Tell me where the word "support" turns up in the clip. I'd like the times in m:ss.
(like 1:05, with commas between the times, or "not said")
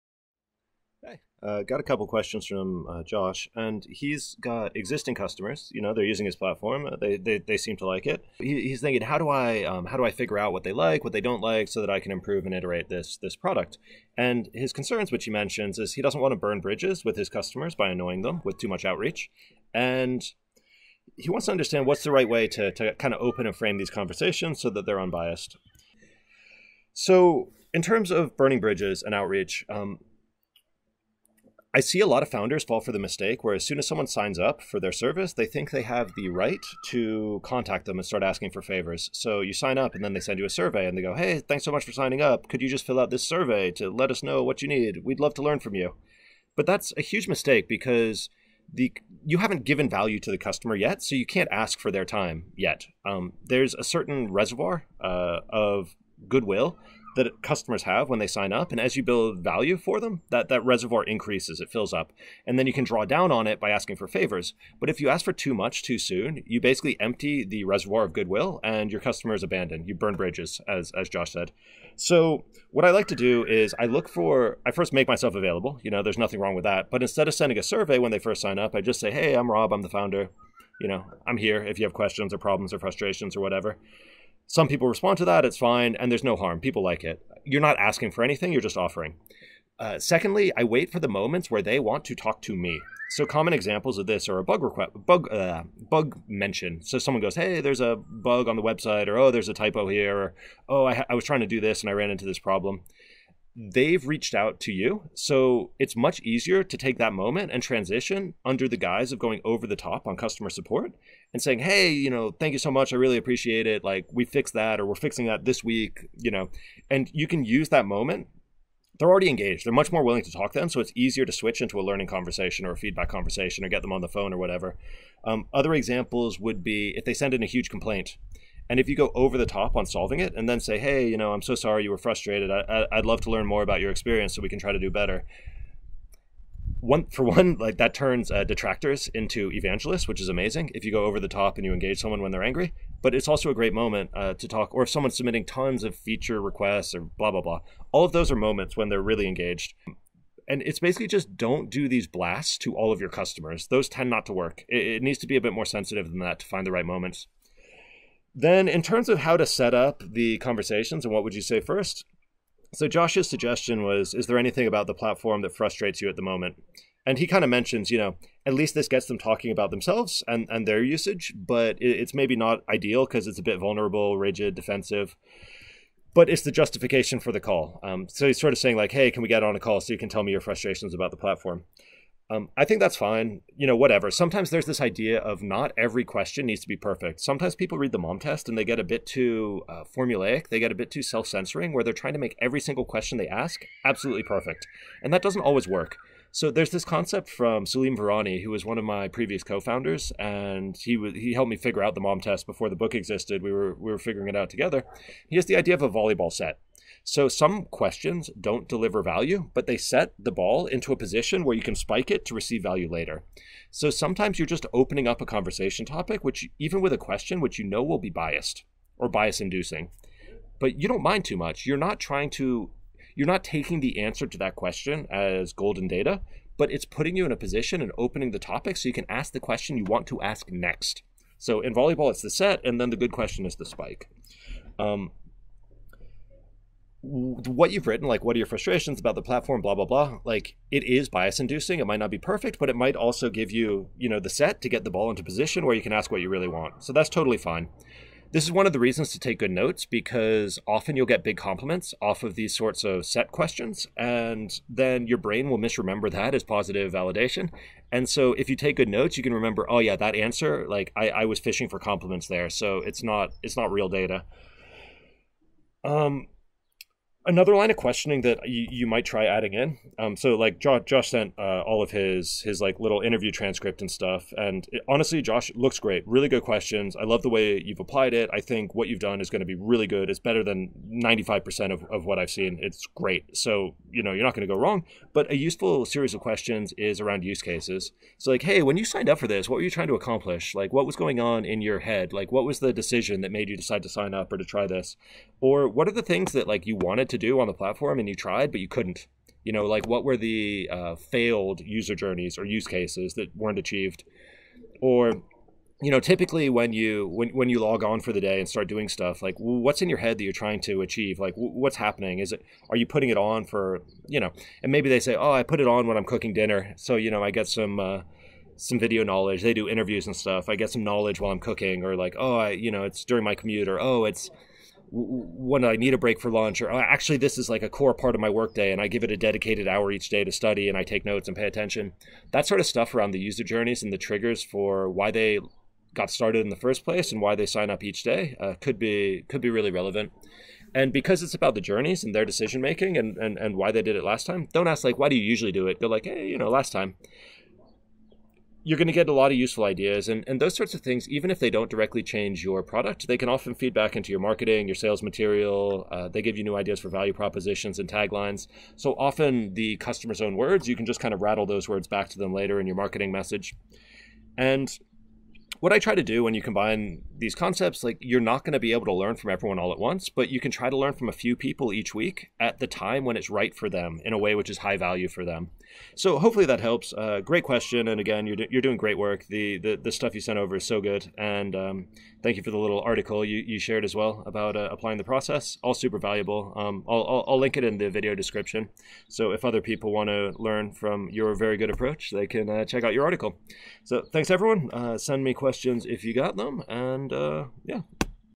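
1:50.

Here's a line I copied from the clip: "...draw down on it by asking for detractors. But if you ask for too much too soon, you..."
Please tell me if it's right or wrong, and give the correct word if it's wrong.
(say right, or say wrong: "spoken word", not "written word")
wrong: "favors", not "detractors".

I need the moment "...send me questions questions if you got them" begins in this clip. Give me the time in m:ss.
6:34.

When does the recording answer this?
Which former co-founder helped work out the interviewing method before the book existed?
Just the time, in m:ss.
3:17.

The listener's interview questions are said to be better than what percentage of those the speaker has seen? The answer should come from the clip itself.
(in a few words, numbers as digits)
95.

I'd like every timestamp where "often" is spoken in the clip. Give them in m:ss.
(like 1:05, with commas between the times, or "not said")
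4:10, 5:53, 5:58.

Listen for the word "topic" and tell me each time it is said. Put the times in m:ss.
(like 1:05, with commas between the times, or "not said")
3:35, 3:48.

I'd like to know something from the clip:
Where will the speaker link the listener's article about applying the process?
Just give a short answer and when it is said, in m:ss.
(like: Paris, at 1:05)
video description, at 6:27.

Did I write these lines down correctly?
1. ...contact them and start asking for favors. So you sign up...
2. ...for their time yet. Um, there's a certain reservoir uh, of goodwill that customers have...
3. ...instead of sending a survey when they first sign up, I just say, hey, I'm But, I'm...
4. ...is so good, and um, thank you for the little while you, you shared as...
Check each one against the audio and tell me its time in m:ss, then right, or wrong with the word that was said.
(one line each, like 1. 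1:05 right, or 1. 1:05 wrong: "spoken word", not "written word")
1. 0:37 right
2. 0:51 right
3. 1:17 wrong: "Rob", not "But"
4. 6:20 wrong: "article", not "while".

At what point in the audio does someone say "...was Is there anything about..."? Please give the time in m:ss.
2:43.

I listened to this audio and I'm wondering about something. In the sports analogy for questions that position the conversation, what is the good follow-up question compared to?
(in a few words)
the spike.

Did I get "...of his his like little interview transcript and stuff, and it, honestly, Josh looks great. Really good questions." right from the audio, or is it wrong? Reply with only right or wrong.
right.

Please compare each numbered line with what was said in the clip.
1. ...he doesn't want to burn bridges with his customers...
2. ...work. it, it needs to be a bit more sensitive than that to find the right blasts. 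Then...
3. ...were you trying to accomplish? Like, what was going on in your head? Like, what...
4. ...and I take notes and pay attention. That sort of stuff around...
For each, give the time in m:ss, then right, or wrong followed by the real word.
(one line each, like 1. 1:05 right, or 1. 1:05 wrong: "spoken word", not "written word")
1. 0:15 right
2. 2:34 wrong: "moments", not "blasts"
3. 4:49 right
4. 5:30 right.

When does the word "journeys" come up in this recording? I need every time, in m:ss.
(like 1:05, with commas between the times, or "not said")
5:01, 5:33, 5:41.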